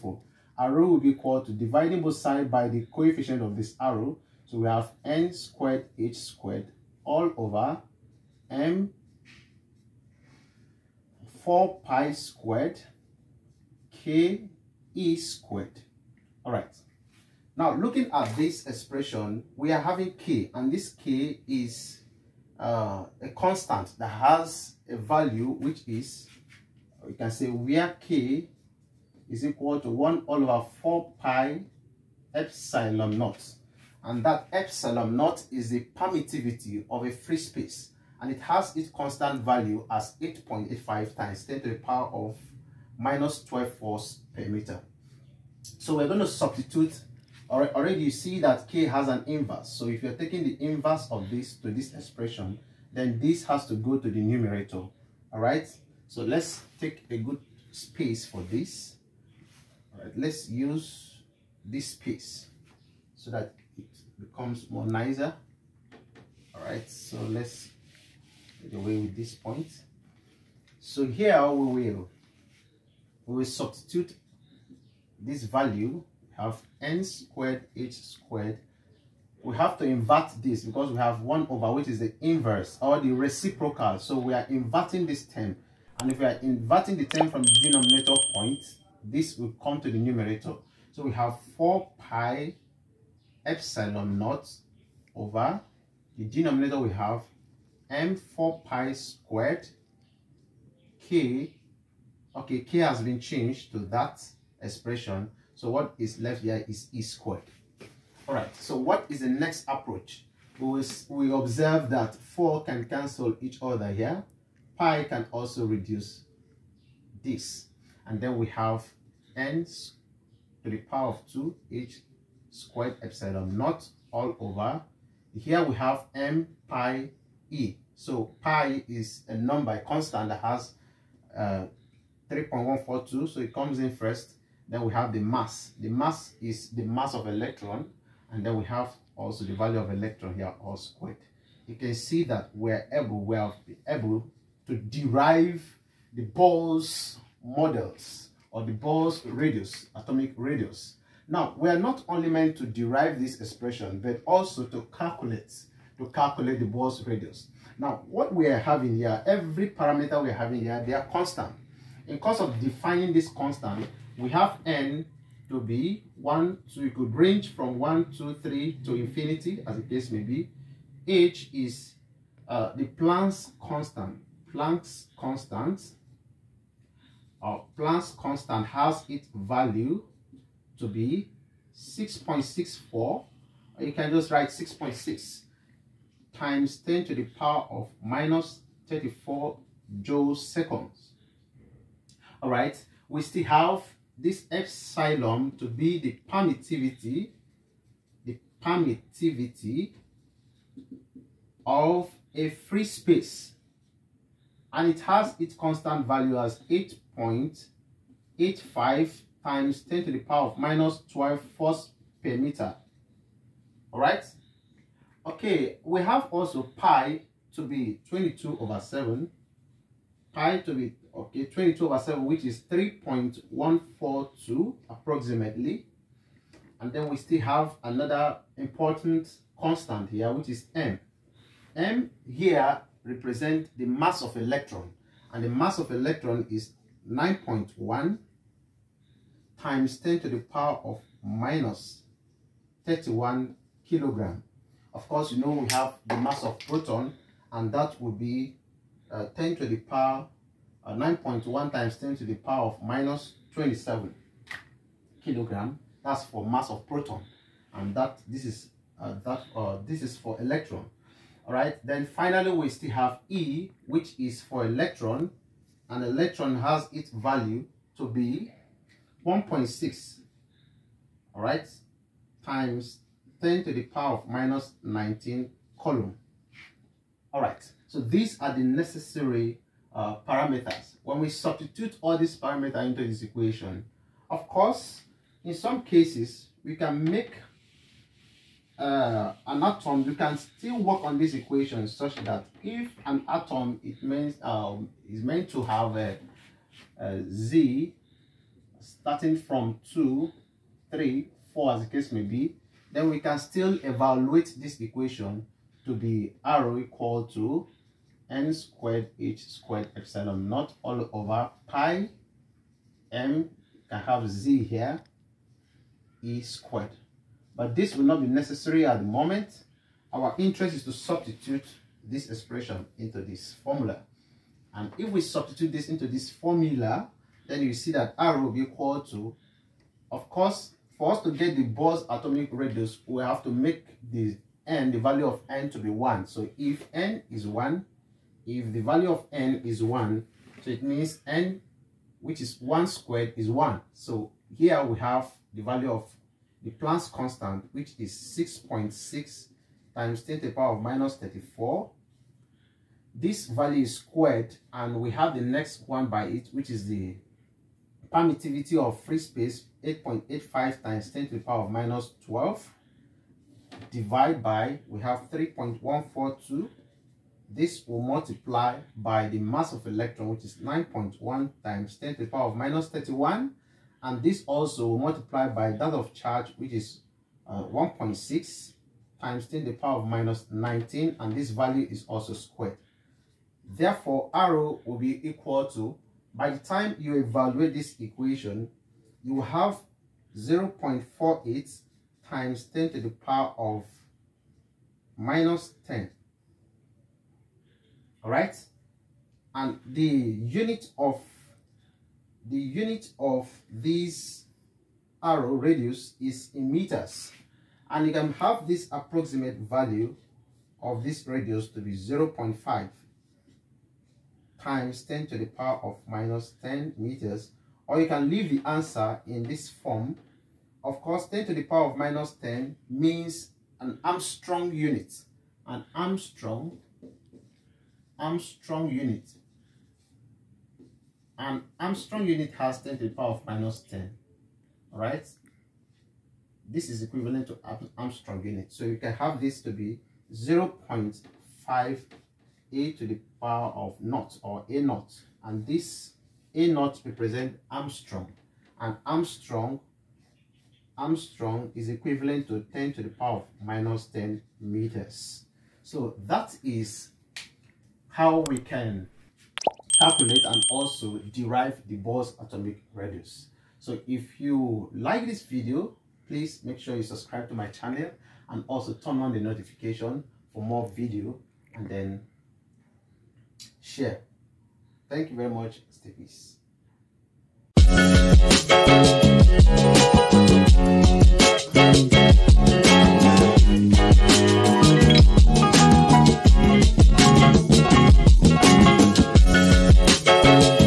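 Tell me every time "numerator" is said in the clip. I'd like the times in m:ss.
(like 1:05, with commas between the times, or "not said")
0:54, 1:29.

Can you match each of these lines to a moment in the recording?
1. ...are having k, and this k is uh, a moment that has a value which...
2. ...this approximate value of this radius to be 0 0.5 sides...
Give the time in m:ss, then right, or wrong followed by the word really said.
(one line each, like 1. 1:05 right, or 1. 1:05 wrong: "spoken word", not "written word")
1. 0:19 wrong: "constant", not "moment"
2. 6:48 wrong: "times", not "sides".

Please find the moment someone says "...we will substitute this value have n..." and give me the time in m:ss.
1:13.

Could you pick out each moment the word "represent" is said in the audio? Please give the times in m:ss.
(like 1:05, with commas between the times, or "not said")
3:53, 7:27.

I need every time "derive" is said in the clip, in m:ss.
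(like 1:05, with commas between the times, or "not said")
2:24, 2:32, 7:41.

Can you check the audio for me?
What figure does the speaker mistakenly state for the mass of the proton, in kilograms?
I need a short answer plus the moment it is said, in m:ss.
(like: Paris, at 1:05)
9.1 × 10^-27 kg, at 4:10.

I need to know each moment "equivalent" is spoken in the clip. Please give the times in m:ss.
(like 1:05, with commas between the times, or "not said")
7:17, 7:31.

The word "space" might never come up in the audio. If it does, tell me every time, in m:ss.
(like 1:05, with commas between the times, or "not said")
0:37, 0:57, 1:01, 3:22, 5:59.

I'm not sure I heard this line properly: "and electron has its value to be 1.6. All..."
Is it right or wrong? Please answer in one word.
right.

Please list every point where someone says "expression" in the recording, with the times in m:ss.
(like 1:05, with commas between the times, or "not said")
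0:18, 0:51, 1:44, 2:33, 5:22.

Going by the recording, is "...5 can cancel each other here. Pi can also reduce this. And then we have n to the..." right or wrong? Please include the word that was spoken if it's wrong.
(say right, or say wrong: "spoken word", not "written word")
wrong: "4", not "5".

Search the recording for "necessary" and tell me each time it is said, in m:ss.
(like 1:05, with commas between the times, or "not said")
4:38, 5:18.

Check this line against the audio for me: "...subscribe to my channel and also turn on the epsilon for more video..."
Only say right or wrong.
wrong.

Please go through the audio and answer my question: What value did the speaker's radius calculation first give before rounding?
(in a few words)
0.48 × 10^-10.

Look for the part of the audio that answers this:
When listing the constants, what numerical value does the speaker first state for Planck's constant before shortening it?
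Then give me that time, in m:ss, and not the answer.
3:01.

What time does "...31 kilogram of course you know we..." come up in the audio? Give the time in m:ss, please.
4:02.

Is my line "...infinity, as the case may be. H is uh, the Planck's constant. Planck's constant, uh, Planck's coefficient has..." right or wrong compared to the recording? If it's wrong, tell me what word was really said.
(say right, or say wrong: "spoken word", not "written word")
wrong: "constant", not "coefficient".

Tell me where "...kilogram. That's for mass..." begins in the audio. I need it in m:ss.
4:15.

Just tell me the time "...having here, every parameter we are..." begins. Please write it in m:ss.
2:38.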